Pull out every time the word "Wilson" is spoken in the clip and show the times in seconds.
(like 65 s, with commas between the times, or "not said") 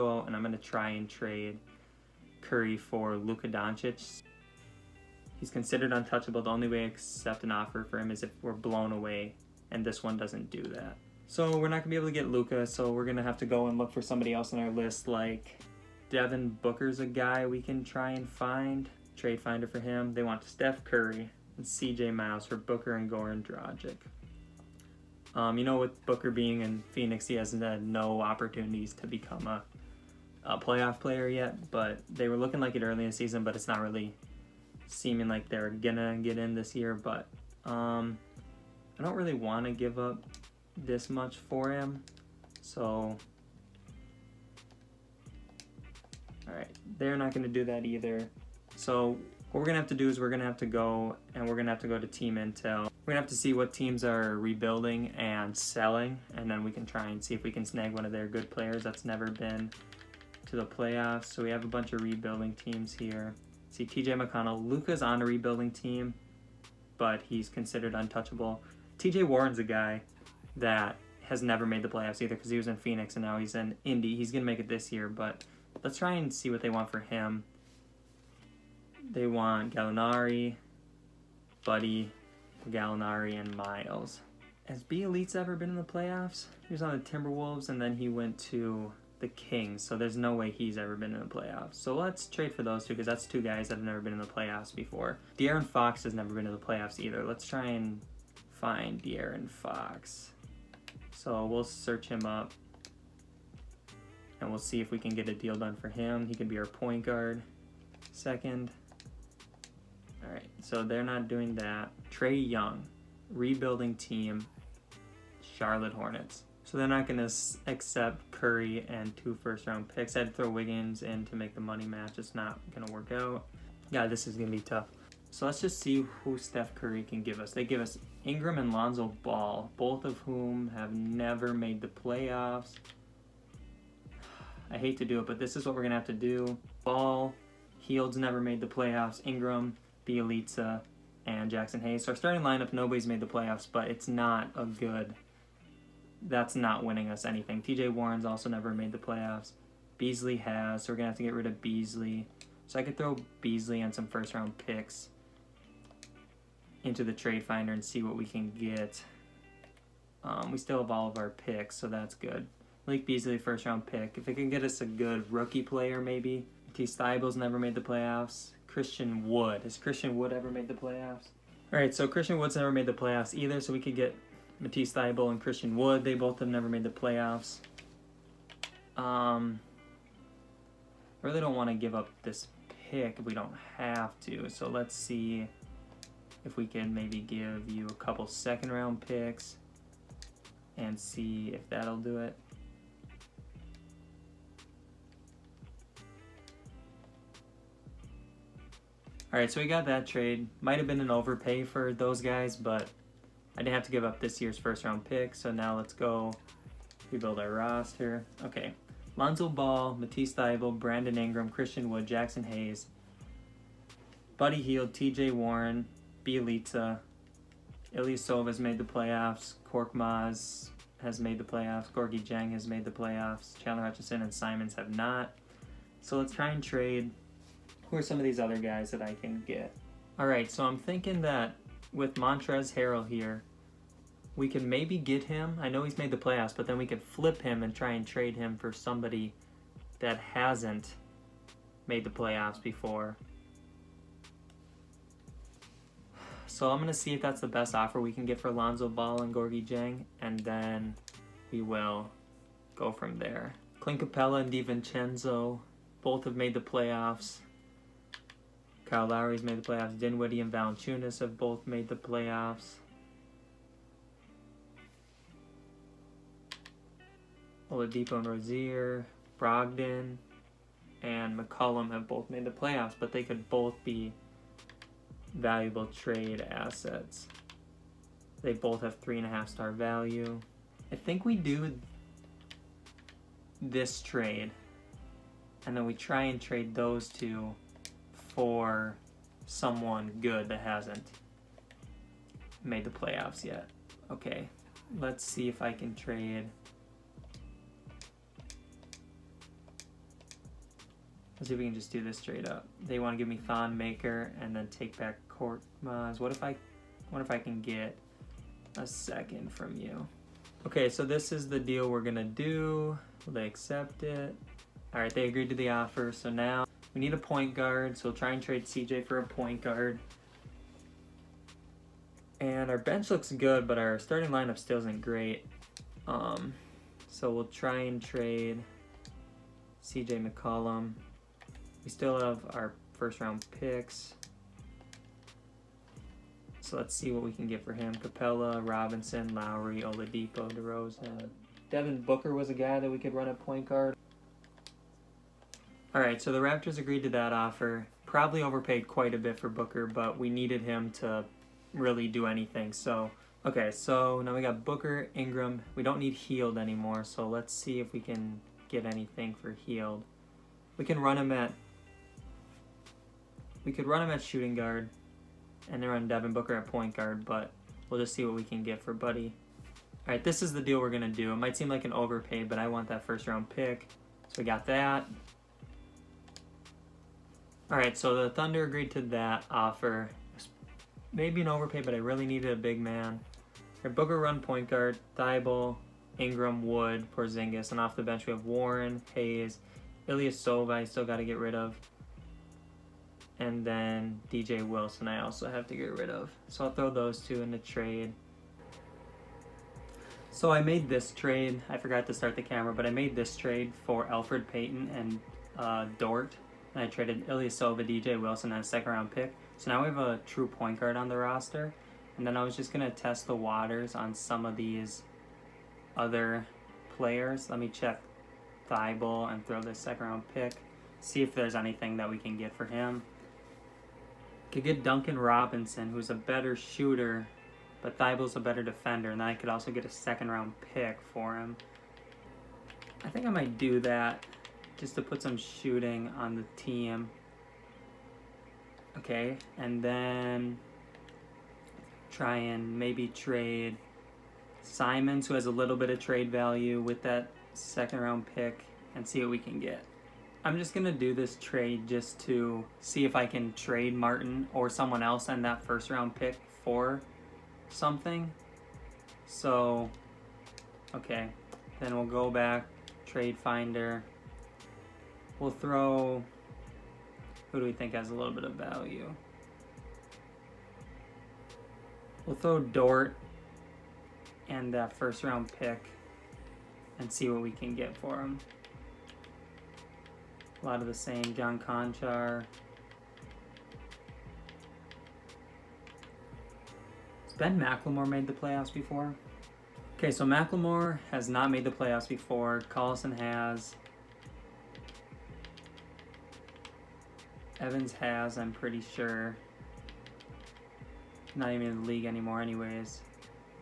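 394 s, 408 s.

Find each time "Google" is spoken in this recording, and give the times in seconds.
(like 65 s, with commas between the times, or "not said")
not said.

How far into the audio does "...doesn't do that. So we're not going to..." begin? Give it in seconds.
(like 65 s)
10 s.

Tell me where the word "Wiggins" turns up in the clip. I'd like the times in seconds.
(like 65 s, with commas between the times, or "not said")
120 s.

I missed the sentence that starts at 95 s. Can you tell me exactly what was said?
De'Aaron Fox has never been in the playoffs either.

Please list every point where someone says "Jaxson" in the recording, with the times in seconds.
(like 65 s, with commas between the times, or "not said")
141 s, 212 s.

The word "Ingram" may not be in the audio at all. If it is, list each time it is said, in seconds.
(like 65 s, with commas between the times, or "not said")
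128 s, 139 s, 211 s, 355 s, 386 s.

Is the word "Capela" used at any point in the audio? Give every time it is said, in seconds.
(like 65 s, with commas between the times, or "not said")
254 s, 337 s.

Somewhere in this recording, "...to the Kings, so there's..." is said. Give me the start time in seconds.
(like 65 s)
88 s.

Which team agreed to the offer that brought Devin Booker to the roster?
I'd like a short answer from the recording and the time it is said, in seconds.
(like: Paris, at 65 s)
Raptors, at 346 s.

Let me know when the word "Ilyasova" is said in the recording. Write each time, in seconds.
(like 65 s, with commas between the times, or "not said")
217 s, 390 s, 407 s.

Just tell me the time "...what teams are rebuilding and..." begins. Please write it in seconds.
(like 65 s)
53 s.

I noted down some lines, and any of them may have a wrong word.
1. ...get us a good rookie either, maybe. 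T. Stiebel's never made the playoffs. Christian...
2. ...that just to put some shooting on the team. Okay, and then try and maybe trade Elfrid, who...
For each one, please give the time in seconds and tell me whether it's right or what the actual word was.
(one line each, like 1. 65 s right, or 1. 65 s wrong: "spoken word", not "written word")
1. 164 s wrong: "player", not "either"
2. 433 s wrong: "Simons", not "Elfrid".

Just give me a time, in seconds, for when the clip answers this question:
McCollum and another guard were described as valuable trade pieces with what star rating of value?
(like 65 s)
278 s.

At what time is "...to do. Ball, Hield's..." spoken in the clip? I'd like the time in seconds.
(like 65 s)
136 s.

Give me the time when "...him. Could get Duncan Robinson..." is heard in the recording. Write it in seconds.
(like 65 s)
422 s.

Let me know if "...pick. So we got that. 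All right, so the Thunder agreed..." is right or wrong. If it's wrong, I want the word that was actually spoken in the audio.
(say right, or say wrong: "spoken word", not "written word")
right.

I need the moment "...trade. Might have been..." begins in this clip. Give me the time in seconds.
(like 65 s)
200 s.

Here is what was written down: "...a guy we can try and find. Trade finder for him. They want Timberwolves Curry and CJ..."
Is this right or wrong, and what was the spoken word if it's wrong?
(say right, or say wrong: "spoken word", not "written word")
wrong: "Steph", not "Timberwolves".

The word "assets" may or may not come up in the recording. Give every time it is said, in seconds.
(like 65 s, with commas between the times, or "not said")
276 s.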